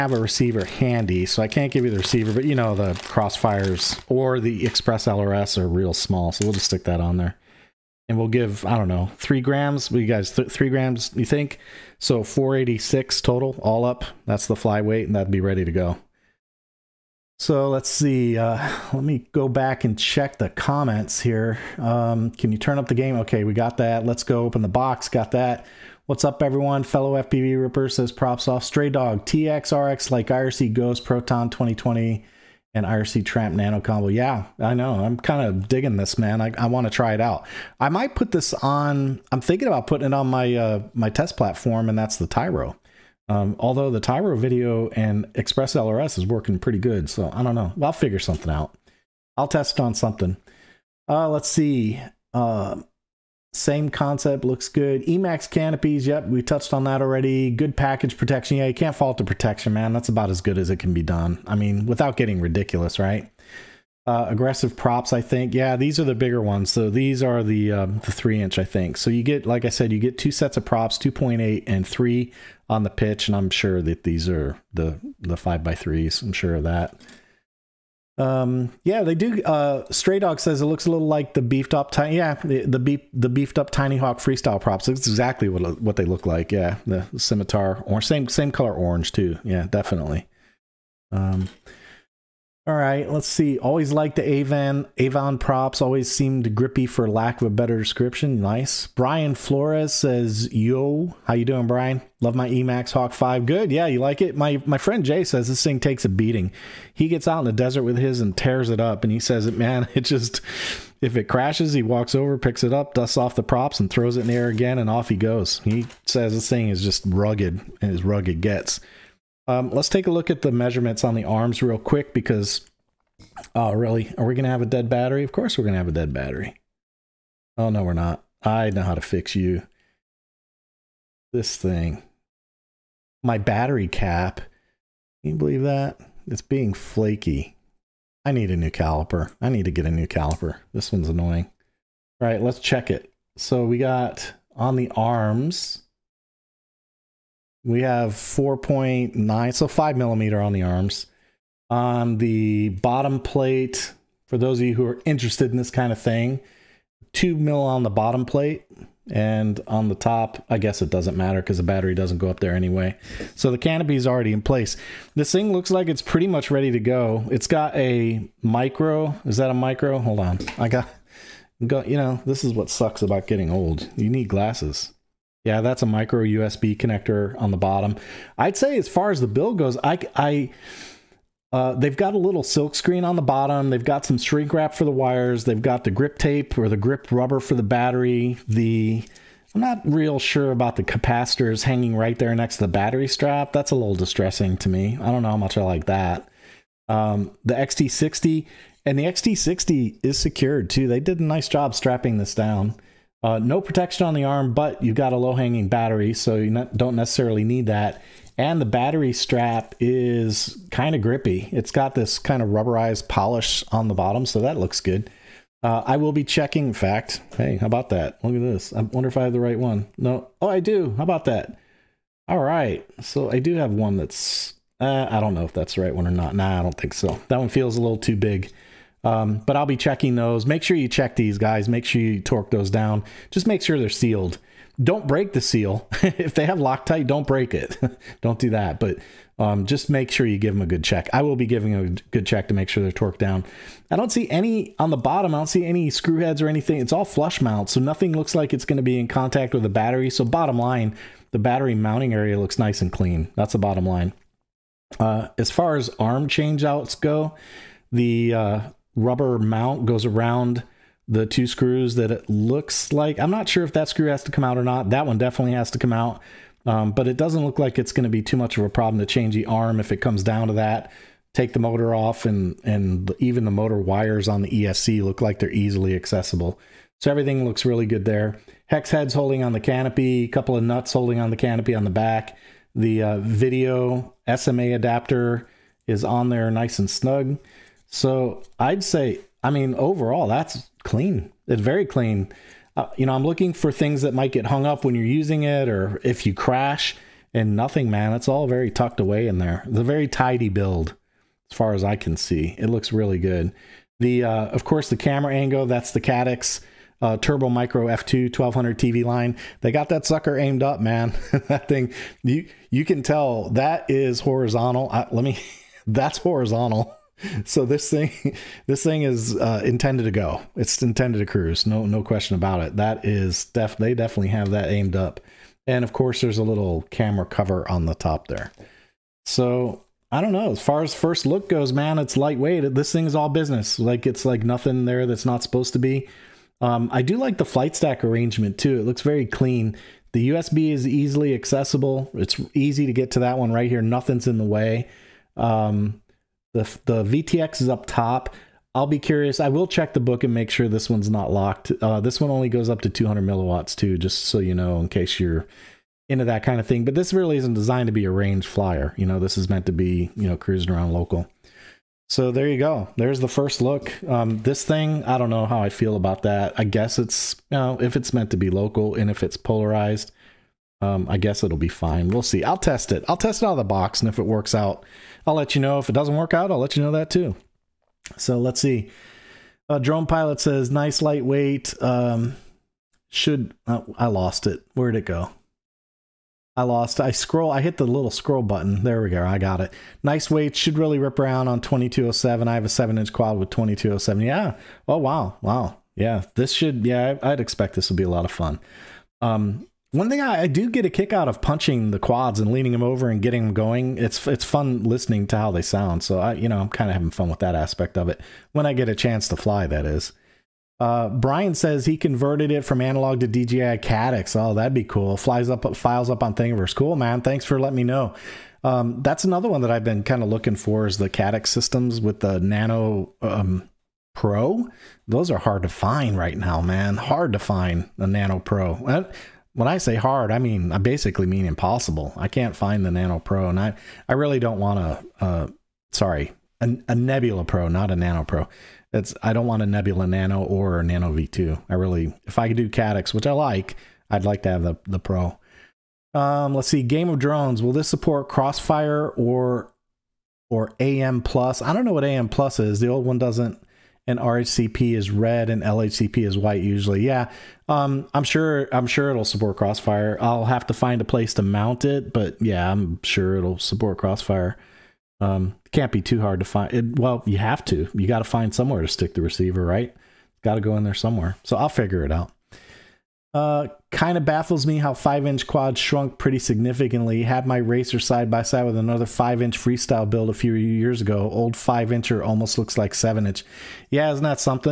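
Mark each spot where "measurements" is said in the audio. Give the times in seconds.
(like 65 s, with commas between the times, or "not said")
120 s.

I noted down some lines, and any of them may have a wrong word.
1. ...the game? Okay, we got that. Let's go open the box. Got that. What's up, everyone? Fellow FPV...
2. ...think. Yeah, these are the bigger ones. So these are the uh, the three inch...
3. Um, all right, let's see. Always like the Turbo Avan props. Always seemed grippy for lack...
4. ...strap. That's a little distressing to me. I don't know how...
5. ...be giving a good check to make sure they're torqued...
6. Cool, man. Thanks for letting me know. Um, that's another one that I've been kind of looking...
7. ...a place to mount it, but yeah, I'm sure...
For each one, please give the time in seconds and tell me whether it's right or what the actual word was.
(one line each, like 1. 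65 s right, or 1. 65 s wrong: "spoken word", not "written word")
1. 22 s right
2. 65 s right
3. 91 s wrong: "Avan", not "Turbo"
4. 193 s right
5. 241 s right
6. 416 s right
7. 461 s right.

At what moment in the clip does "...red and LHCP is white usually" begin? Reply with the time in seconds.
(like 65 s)
455 s.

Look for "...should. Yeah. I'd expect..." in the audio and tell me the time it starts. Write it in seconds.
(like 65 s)
396 s.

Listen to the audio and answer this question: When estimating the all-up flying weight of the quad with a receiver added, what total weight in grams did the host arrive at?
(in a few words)
486.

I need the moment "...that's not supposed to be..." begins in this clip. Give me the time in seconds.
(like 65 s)
335 s.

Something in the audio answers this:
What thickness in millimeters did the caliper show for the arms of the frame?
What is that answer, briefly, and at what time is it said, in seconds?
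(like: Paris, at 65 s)
5, at 149 s.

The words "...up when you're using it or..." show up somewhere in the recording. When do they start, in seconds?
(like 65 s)
294 s.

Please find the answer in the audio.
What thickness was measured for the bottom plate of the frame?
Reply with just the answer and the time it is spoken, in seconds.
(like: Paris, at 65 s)
2 mil, at 157 s.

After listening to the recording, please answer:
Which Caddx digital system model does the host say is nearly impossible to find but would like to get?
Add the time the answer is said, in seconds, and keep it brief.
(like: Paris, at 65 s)
Nebula Pro, at 436 s.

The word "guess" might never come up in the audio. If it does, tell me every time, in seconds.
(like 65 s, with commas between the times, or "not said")
160 s, 366 s, 371 s.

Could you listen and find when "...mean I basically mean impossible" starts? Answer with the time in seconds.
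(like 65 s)
430 s.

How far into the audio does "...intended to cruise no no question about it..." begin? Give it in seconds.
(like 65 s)
320 s.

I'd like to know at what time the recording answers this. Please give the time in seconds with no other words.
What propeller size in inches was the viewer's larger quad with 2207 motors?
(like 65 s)
392 s.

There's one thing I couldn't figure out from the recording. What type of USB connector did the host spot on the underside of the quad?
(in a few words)
micro USB.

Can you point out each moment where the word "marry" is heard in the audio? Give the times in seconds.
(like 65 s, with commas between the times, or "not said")
not said.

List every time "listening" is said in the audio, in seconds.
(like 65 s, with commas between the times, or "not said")
404 s.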